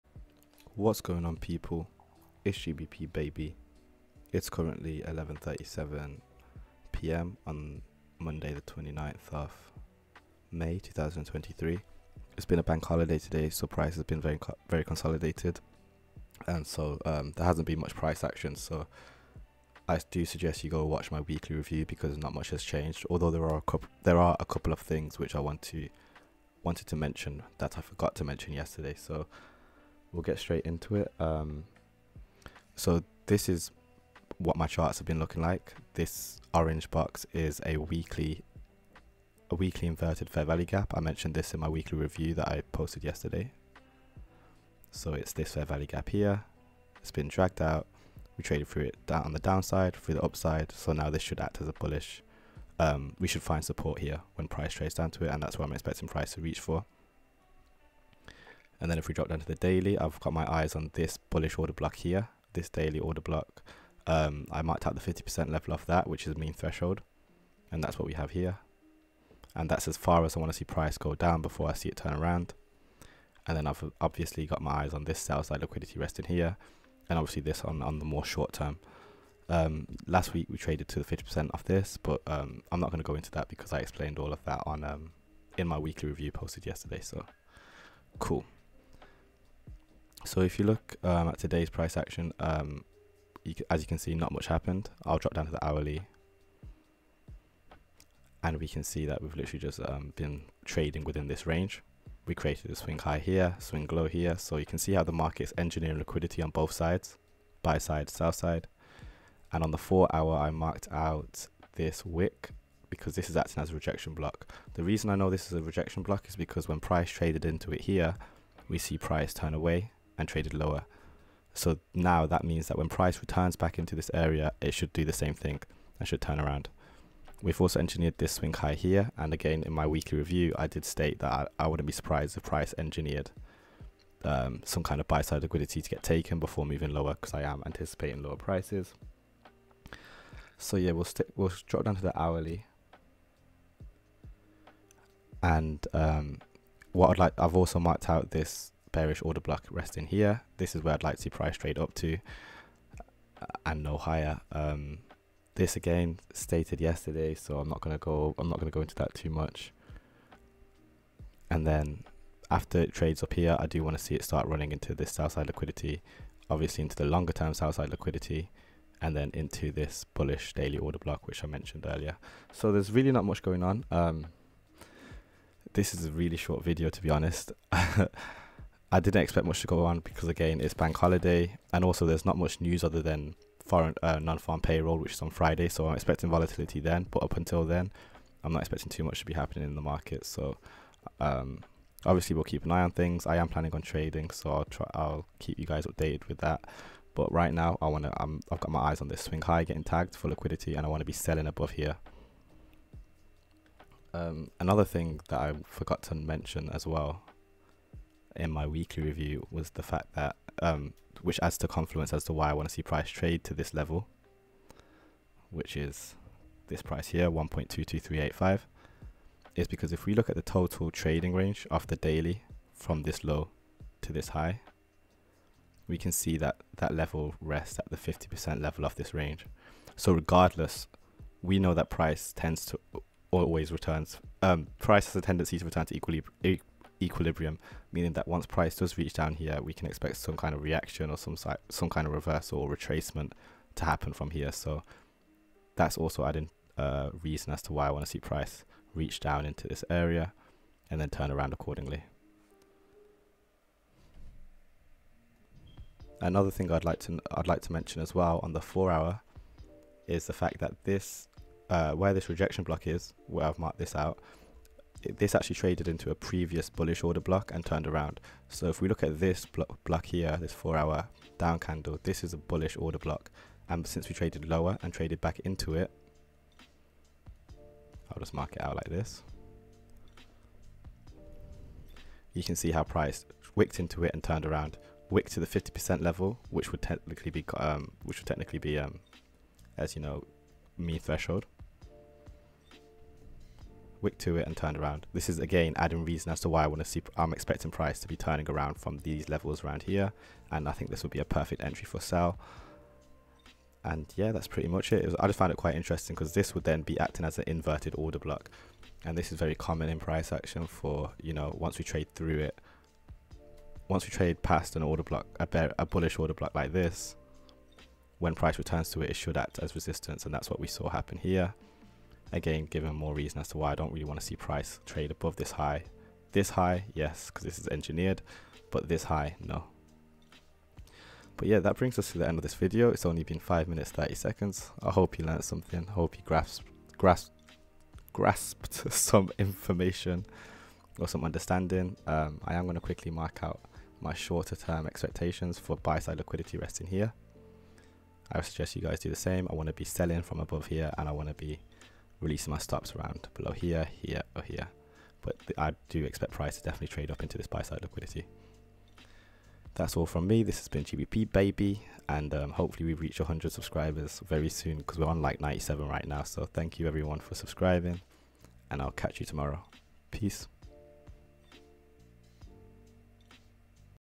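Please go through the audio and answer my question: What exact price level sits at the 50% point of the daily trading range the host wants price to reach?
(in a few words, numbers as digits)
1.22385.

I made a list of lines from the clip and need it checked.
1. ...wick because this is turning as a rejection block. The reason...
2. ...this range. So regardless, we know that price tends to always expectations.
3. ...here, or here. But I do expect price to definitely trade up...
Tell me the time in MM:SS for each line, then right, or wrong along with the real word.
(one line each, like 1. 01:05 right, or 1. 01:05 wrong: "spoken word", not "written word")
1. 01:52 wrong: "acting", not "turning"
2. 03:48 wrong: "returns", not "expectations"
3. 05:54 right.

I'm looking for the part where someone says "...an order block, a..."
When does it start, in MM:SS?
05:14.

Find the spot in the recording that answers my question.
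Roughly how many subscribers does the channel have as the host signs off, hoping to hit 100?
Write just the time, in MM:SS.
06:05.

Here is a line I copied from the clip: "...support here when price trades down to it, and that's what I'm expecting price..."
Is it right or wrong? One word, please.
right.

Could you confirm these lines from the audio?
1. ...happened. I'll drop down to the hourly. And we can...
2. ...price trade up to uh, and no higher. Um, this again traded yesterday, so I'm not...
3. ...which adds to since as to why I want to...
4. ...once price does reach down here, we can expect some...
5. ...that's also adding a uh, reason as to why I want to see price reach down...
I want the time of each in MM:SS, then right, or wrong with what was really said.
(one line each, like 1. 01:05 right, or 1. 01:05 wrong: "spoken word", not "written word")
1. 01:34 right
2. 02:31 wrong: "stated", not "traded"
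3. 03:31 wrong: "confluence", not "since"
4. 03:58 right
5. 04:05 right.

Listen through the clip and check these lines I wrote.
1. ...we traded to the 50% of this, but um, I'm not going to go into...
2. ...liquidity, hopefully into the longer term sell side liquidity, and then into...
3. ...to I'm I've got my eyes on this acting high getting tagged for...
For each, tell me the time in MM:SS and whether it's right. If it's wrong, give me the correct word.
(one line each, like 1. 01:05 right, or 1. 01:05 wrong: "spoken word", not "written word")
1. 01:20 right
2. 02:45 wrong: "obviously", not "hopefully"
3. 03:18 wrong: "swing", not "acting".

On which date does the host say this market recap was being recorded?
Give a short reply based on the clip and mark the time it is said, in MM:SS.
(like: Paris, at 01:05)
Monday 29 May 2023, at 00:08.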